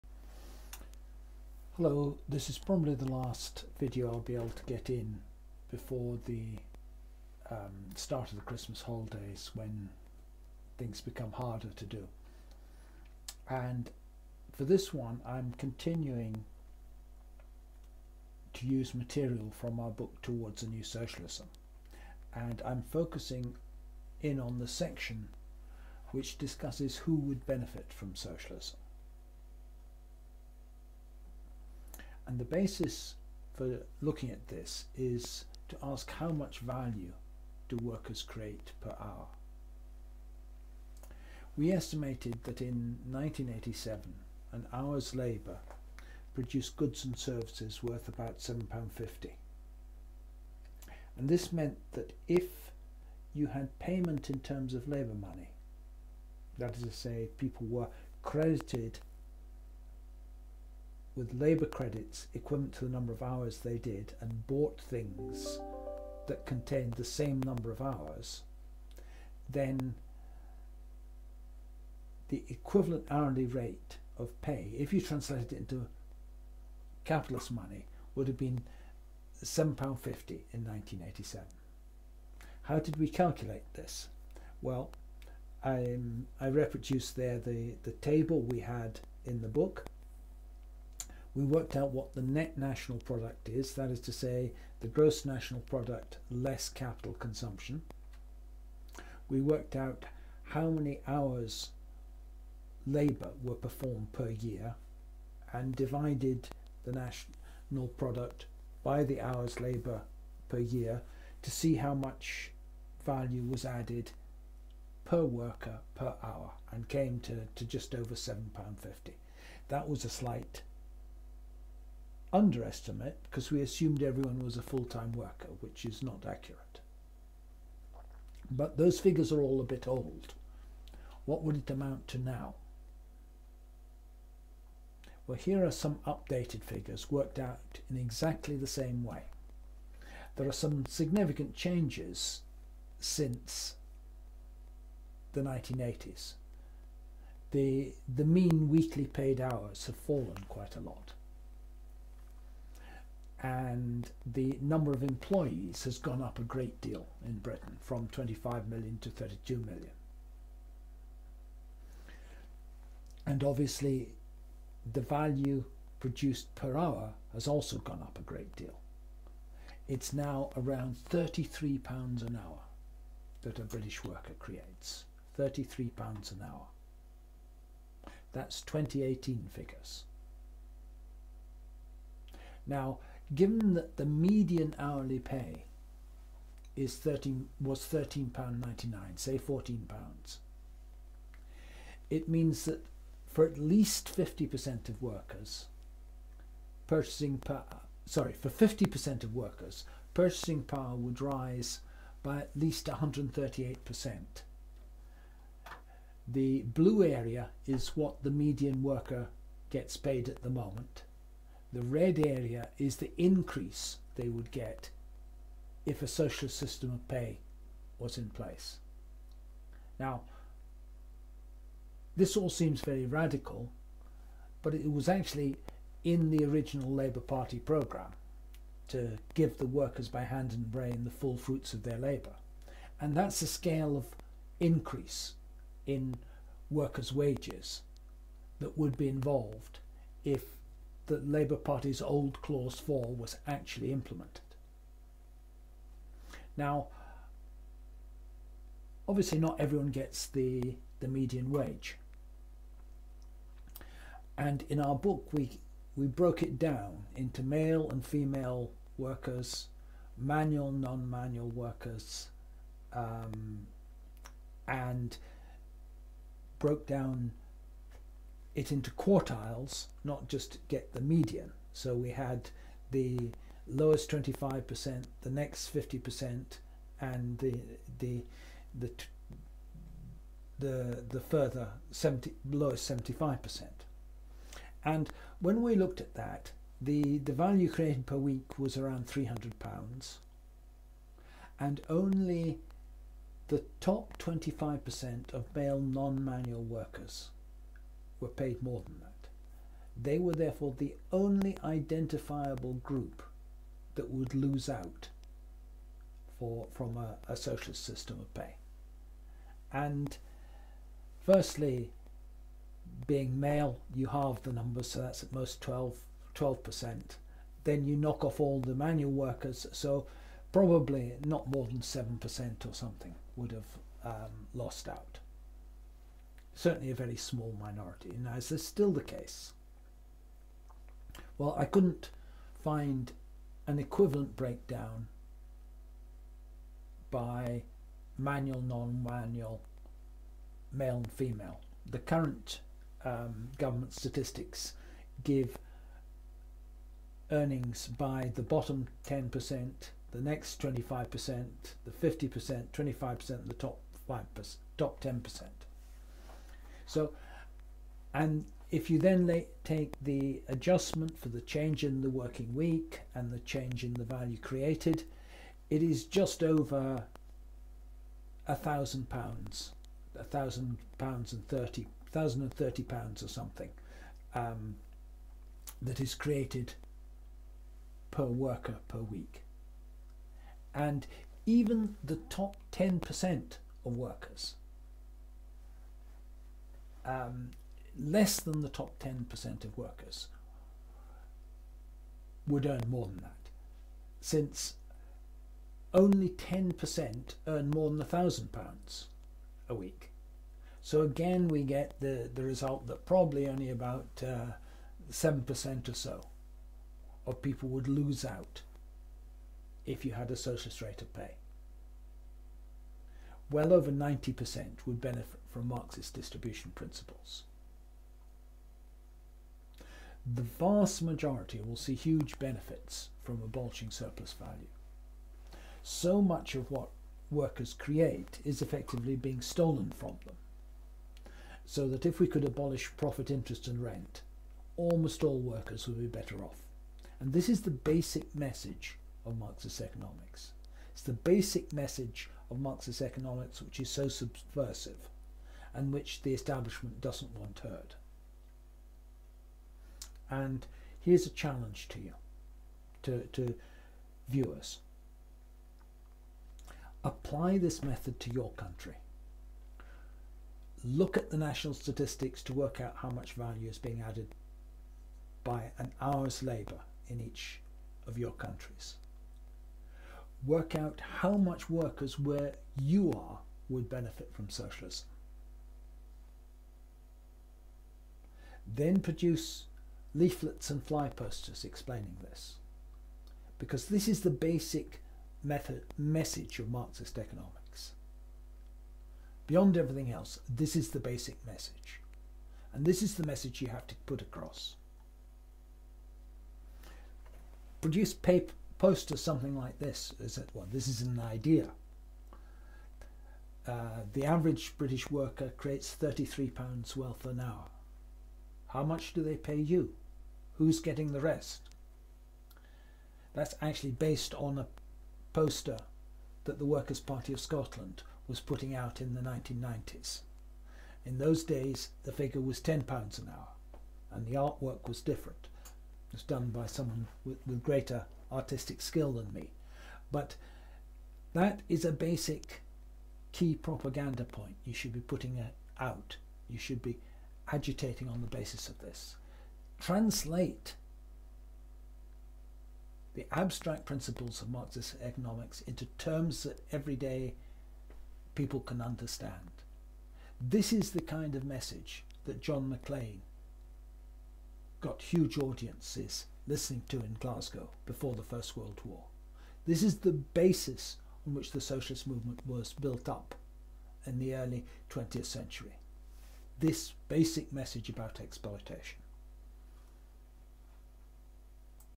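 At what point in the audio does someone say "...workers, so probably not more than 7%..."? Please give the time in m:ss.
5:19.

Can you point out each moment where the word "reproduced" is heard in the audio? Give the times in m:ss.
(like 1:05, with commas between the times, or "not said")
1:26.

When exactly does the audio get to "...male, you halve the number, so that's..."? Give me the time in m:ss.
5:13.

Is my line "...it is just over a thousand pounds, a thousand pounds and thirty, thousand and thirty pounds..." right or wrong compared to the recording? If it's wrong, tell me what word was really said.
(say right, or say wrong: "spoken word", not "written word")
right.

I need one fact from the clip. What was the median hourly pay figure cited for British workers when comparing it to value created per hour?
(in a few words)
£13.99.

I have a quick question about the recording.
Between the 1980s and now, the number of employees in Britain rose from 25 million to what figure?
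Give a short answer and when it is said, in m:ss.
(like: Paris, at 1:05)
32 million, at 2:39.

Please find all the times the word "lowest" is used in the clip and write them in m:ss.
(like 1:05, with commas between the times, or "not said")
4:33, 4:42.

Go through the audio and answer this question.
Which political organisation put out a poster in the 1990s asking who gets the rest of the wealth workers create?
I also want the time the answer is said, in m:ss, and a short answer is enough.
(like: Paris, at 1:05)
Workers' Party of Scotland, at 8:36.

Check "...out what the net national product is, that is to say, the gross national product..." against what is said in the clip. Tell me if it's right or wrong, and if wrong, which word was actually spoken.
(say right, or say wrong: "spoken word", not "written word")
right.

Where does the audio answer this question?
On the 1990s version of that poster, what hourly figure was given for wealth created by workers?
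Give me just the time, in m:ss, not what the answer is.
8:42.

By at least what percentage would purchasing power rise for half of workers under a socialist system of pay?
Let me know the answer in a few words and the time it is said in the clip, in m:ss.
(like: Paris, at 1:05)
138%, at 3:22.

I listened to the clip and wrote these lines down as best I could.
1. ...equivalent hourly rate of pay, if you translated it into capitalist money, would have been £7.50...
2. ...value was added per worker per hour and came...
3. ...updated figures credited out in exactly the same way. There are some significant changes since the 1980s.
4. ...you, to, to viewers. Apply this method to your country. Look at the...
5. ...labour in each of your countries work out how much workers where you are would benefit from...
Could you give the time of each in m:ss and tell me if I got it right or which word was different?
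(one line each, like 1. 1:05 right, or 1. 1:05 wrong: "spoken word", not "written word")
1. 1:12 right
2. 1:53 right
3. 2:16 wrong: "worked", not "credited"
4. 7:31 right
5. 7:46 right.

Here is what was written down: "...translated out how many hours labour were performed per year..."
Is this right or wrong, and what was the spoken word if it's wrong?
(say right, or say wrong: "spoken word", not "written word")
wrong: "worked", not "translated".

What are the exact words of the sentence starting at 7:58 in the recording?
Then produce leaflets and fly posters explaining this.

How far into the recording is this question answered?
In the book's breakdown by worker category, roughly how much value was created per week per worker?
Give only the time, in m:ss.
4:49.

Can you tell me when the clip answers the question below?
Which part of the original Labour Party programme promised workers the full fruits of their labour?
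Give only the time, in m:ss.
4:02.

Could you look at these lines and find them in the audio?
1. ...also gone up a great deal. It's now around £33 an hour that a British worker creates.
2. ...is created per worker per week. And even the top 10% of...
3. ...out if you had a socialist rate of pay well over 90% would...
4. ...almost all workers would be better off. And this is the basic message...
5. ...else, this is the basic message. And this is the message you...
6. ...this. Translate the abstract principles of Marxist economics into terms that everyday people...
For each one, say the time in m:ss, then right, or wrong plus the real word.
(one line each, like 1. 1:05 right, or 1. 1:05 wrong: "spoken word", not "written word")
1. 2:47 right
2. 6:16 right
3. 6:48 right
4. 7:14 right
5. 8:10 right
6. 8:58 right.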